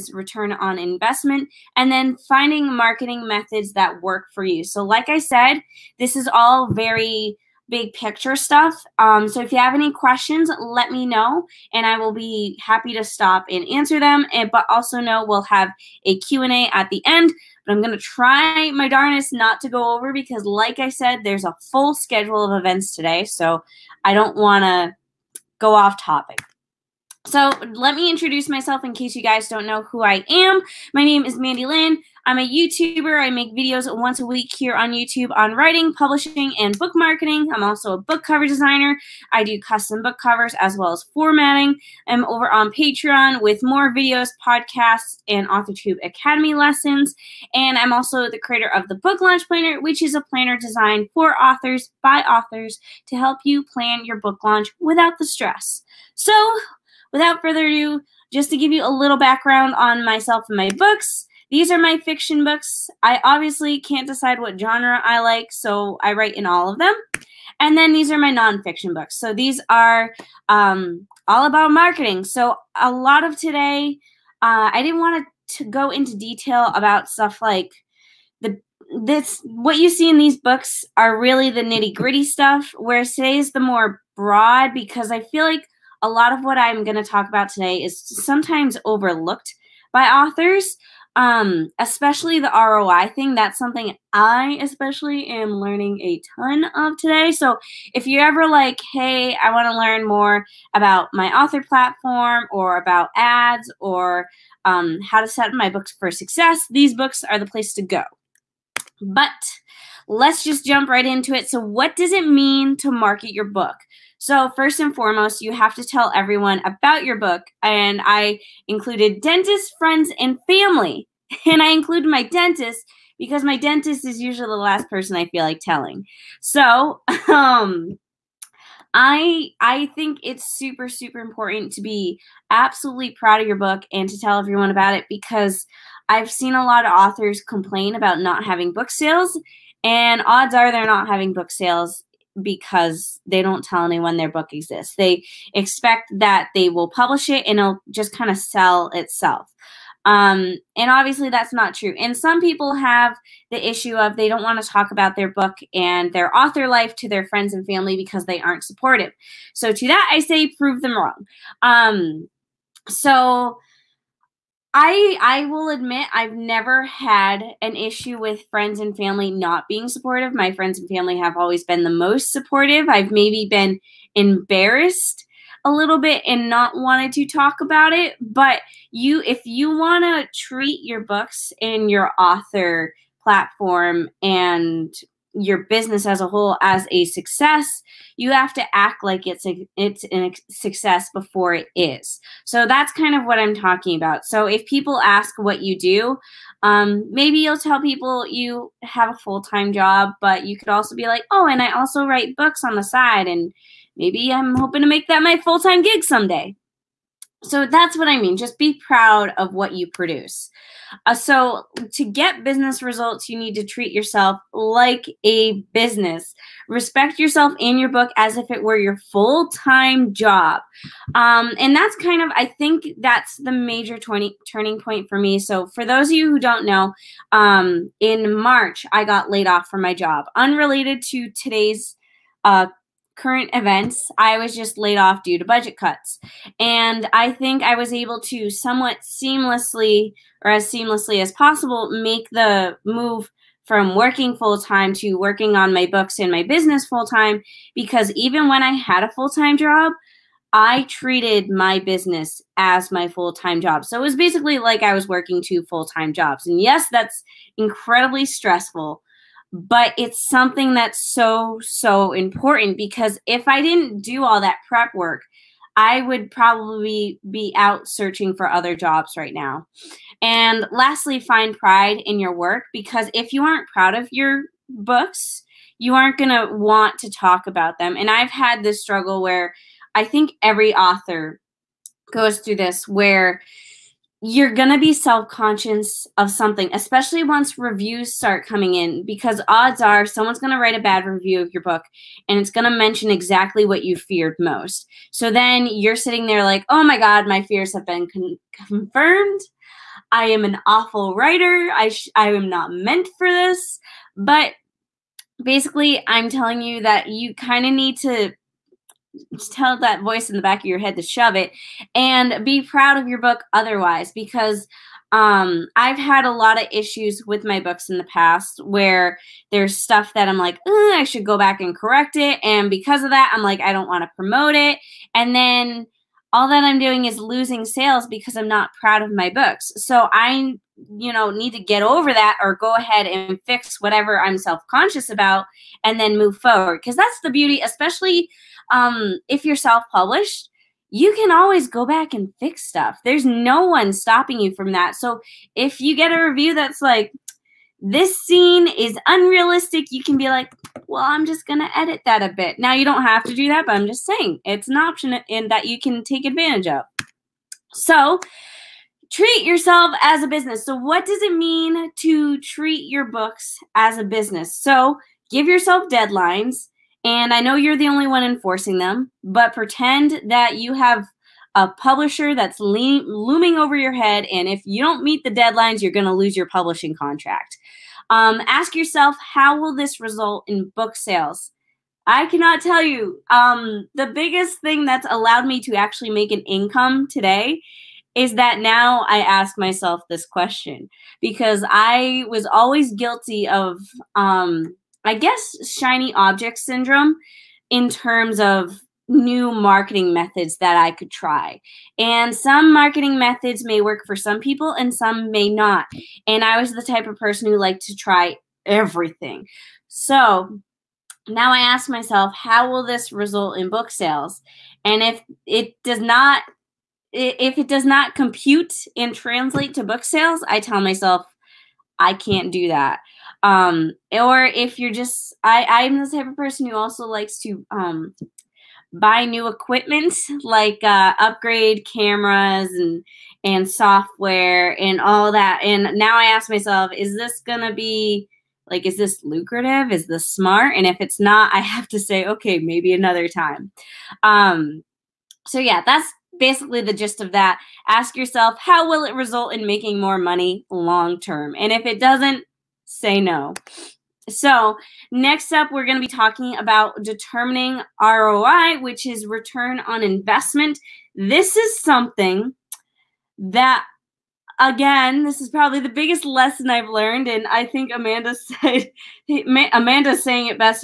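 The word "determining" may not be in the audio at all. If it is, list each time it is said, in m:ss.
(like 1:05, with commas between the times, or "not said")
7:37.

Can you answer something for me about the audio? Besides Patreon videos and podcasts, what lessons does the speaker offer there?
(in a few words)
AuthorTube Academy.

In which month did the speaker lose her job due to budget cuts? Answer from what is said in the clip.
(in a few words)
March.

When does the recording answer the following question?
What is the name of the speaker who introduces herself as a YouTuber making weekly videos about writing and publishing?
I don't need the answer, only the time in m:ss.
0:31.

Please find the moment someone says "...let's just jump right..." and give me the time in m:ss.
1:50.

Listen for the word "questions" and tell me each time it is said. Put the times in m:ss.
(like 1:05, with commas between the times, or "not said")
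0:09, 6:30.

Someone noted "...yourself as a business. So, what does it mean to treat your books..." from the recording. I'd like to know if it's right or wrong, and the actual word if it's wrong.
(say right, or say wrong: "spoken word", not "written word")
right.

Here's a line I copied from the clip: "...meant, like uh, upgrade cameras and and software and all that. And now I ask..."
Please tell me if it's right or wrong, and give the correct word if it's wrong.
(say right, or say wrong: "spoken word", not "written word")
wrong: "equipment", not "meant".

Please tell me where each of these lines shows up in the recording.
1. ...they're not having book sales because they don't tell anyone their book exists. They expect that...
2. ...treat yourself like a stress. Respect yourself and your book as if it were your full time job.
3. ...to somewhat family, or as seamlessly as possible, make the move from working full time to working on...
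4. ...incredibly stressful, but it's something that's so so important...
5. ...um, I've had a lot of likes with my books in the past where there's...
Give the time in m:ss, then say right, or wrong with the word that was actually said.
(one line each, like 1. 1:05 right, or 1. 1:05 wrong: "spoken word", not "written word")
1. 2:20 right
2. 3:33 wrong: "business", not "stress"
3. 3:58 wrong: "seamlessly", not "family"
4. 4:17 right
5. 5:15 wrong: "issues", not "likes".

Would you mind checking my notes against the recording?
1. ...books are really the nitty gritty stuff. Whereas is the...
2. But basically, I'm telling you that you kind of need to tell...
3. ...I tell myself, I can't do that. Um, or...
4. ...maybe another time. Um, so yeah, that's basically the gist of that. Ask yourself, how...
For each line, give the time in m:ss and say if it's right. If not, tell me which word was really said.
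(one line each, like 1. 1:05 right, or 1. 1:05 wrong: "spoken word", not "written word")
1. 1:20 right
2. 5:04 right
3. 7:00 right
4. 7:22 right.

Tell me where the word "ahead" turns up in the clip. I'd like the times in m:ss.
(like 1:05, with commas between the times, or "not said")
5:32.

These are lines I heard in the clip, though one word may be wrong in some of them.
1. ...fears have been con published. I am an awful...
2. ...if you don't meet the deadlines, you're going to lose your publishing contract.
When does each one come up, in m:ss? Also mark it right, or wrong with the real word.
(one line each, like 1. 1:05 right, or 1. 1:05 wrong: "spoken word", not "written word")
1. 4:57 wrong: "confirmed", not "published"
2. 6:14 right.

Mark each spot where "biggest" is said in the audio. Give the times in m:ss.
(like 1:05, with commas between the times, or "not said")
6:24, 7:45.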